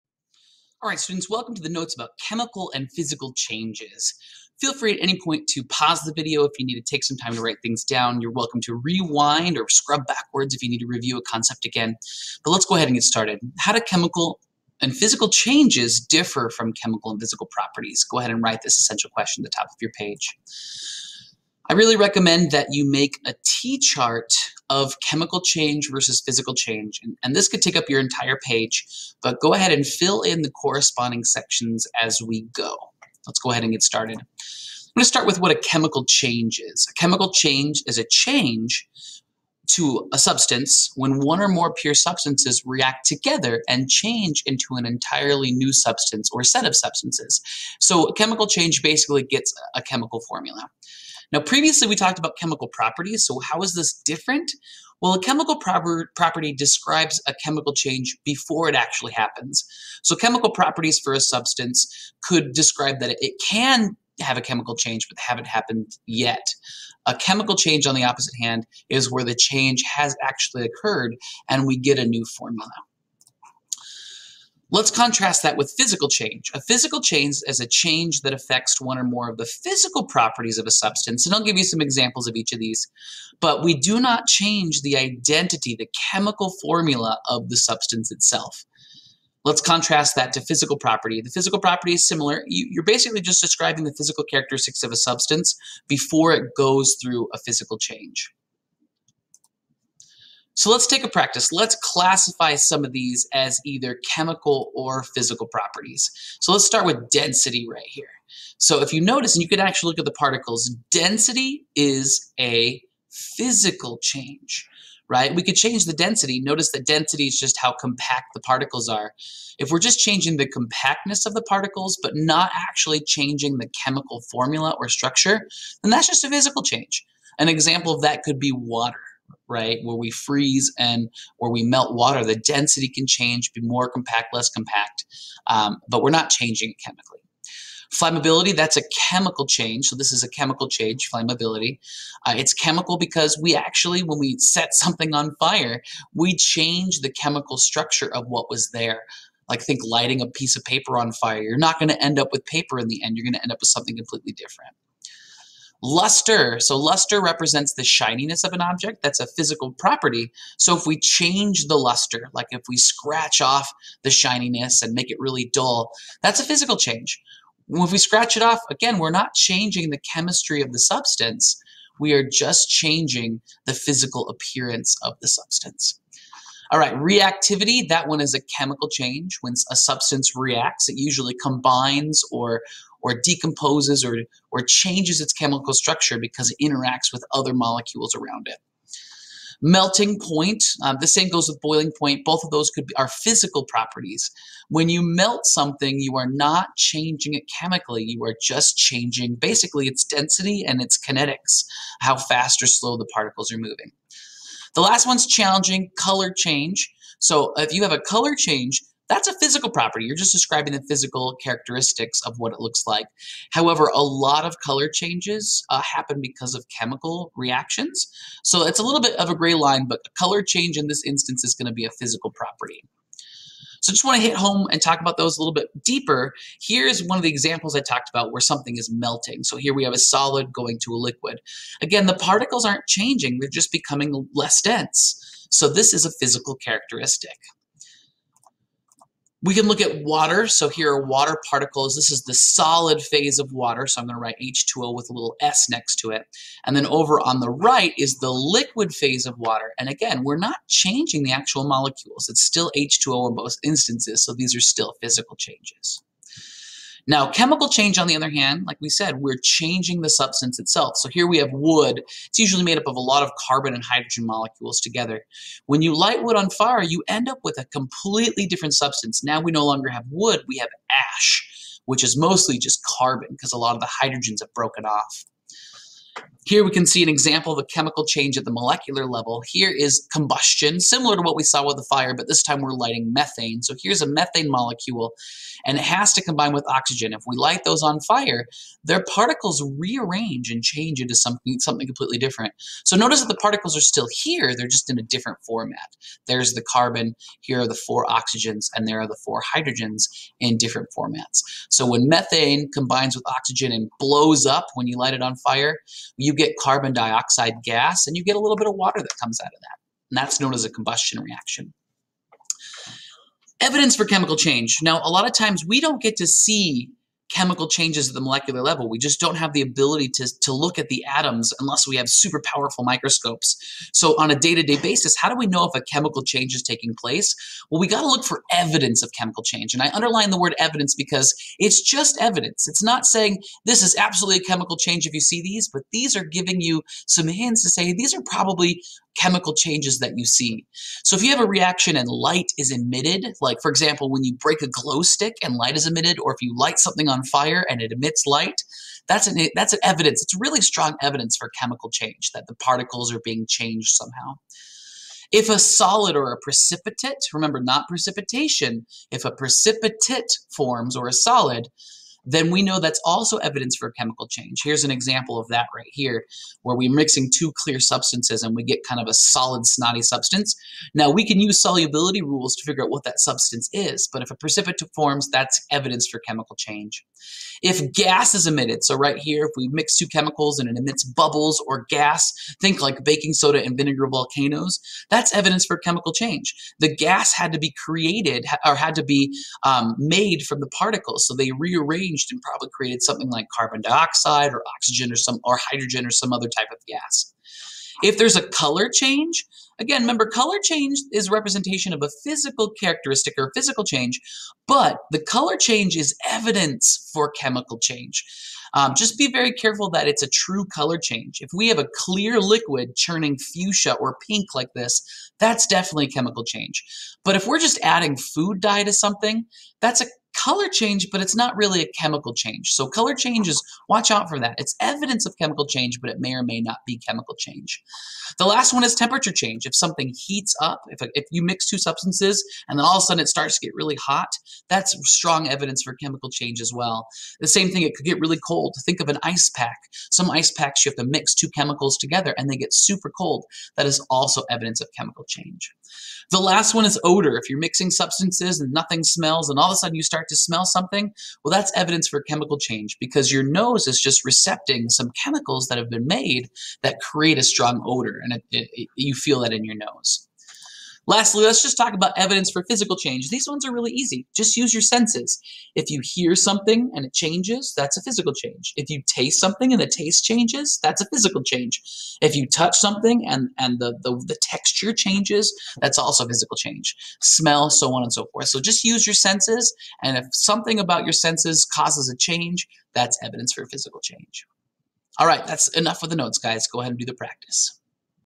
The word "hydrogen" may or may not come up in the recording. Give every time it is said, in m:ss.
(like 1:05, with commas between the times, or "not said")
4:23, 4:34, 4:59, 6:35.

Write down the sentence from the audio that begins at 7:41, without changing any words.
Lastly, let's just talk about evidence for physical change.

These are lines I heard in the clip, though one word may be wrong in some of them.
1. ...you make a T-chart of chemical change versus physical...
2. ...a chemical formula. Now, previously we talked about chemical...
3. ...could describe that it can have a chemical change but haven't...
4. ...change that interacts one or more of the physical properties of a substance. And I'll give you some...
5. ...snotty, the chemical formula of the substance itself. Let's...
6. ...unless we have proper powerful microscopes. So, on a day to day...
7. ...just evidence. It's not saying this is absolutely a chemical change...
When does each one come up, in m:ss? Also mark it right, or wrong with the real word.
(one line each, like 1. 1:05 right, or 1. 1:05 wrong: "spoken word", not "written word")
1. 0:22 right
2. 0:49 right
3. 1:02 right
4. 1:17 wrong: "affects", not "interacts"
5. 1:24 wrong: "identity", not "snotty"
6. 5:21 wrong: "super", not "proper"
7. 5:31 right.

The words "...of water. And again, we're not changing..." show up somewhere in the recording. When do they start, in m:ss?
4:09.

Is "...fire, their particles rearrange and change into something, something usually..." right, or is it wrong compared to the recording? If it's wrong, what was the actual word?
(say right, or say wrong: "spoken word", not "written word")
wrong: "completely", not "usually".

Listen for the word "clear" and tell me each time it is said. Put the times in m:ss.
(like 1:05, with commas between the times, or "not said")
6:07, 6:51.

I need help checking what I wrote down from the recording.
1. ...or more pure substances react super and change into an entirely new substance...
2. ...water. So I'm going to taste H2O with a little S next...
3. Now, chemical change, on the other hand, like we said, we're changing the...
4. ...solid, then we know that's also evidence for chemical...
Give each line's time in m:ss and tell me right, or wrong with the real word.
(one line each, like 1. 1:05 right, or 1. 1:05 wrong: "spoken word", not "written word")
1. 0:41 wrong: "together", not "super"
2. 4:03 wrong: "write", not "taste"
3. 4:17 right
4. 6:01 right.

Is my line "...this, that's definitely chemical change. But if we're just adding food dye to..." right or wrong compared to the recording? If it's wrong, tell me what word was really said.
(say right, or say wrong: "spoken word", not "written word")
right.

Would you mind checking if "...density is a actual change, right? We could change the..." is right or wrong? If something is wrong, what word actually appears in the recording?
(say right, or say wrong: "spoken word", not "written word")
wrong: "physical", not "actual".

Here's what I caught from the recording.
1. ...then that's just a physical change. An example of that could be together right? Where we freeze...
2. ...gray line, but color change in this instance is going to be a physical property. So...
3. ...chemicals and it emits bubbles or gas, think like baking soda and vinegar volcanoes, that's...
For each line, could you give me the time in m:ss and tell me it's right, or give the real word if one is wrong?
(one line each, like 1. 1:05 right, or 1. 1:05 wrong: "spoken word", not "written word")
1. 2:05 wrong: "water", not "together"
2. 3:39 right
3. 6:20 right.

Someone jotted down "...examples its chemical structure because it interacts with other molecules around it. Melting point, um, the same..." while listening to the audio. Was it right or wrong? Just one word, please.
wrong.